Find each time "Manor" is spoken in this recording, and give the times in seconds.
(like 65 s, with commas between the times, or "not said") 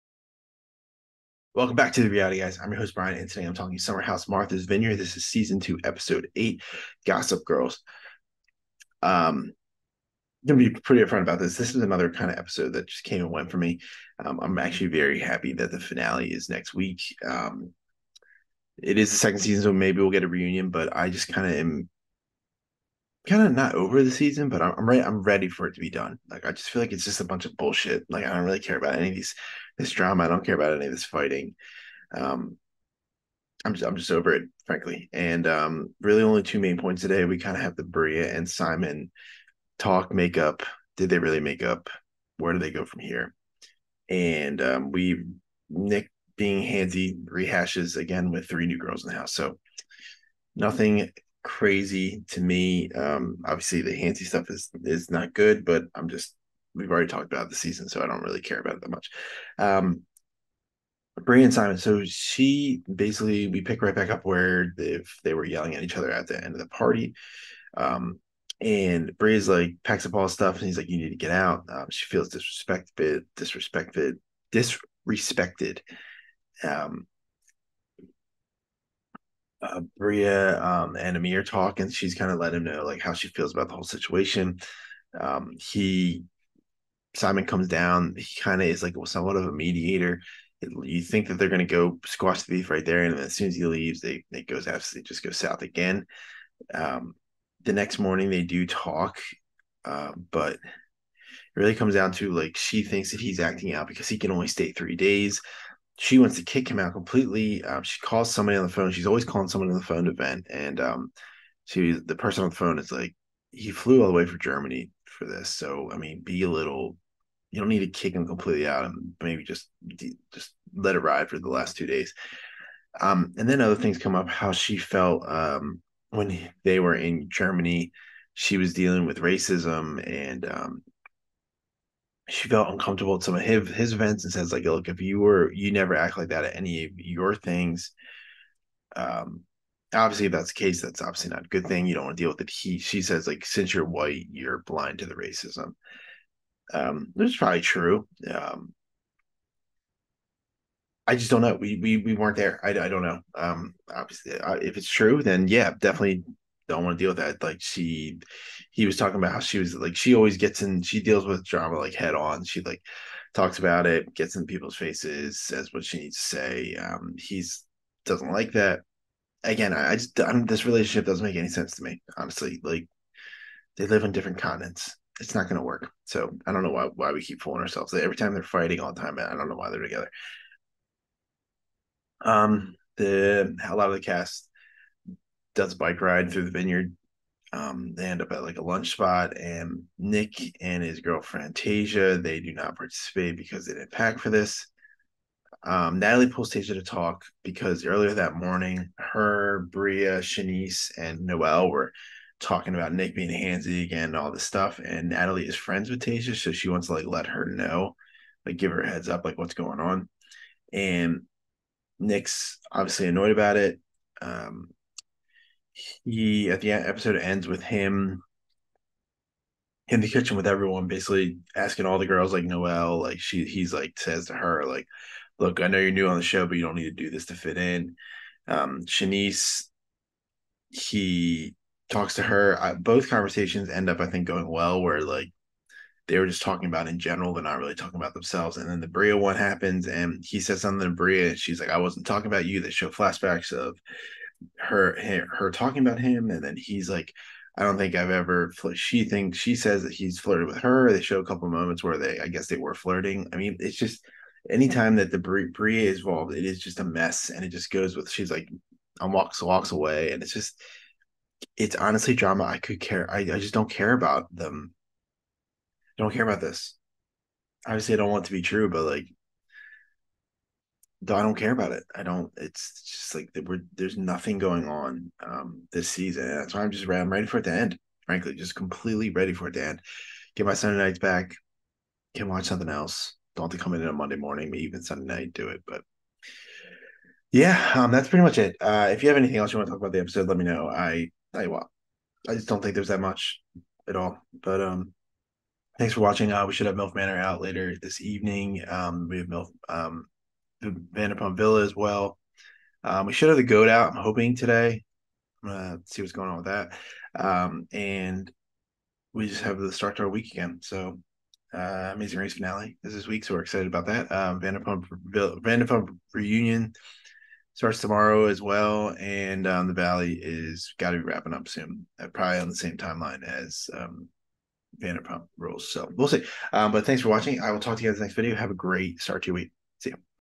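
296 s.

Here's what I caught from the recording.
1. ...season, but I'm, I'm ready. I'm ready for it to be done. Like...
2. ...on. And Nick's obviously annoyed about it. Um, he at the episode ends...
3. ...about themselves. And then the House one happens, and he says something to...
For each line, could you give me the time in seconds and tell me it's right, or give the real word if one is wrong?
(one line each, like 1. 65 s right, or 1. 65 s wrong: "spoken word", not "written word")
1. 24 s right
2. 209 s right
3. 237 s wrong: "Bria", not "House".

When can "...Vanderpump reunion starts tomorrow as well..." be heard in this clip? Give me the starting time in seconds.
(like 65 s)
315 s.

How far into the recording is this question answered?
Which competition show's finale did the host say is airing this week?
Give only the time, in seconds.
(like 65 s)
311 s.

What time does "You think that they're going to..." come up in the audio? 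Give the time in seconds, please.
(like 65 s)
90 s.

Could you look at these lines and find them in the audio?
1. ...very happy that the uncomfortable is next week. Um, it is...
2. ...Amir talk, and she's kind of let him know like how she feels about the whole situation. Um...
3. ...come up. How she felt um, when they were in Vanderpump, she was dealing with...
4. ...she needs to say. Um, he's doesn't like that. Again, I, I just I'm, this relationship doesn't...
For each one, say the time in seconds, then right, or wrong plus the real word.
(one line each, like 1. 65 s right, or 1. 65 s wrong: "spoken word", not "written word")
1. 14 s wrong: "finale", not "uncomfortable"
2. 81 s right
3. 123 s wrong: "Germany", not "Vanderpump"
4. 165 s right.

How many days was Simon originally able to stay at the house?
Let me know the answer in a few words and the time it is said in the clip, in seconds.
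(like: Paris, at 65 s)
3, at 104 s.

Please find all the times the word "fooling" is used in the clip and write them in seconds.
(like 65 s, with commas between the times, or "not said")
177 s.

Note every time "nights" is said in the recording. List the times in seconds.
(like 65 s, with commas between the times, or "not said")
280 s, 285 s.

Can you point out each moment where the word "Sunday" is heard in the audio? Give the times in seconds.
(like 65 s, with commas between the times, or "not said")
280 s, 284 s.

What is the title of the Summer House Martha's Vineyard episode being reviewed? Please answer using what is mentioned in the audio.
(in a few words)
Gossip Girls.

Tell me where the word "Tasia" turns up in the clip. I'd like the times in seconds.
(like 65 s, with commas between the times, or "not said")
191 s, 196 s, 206 s.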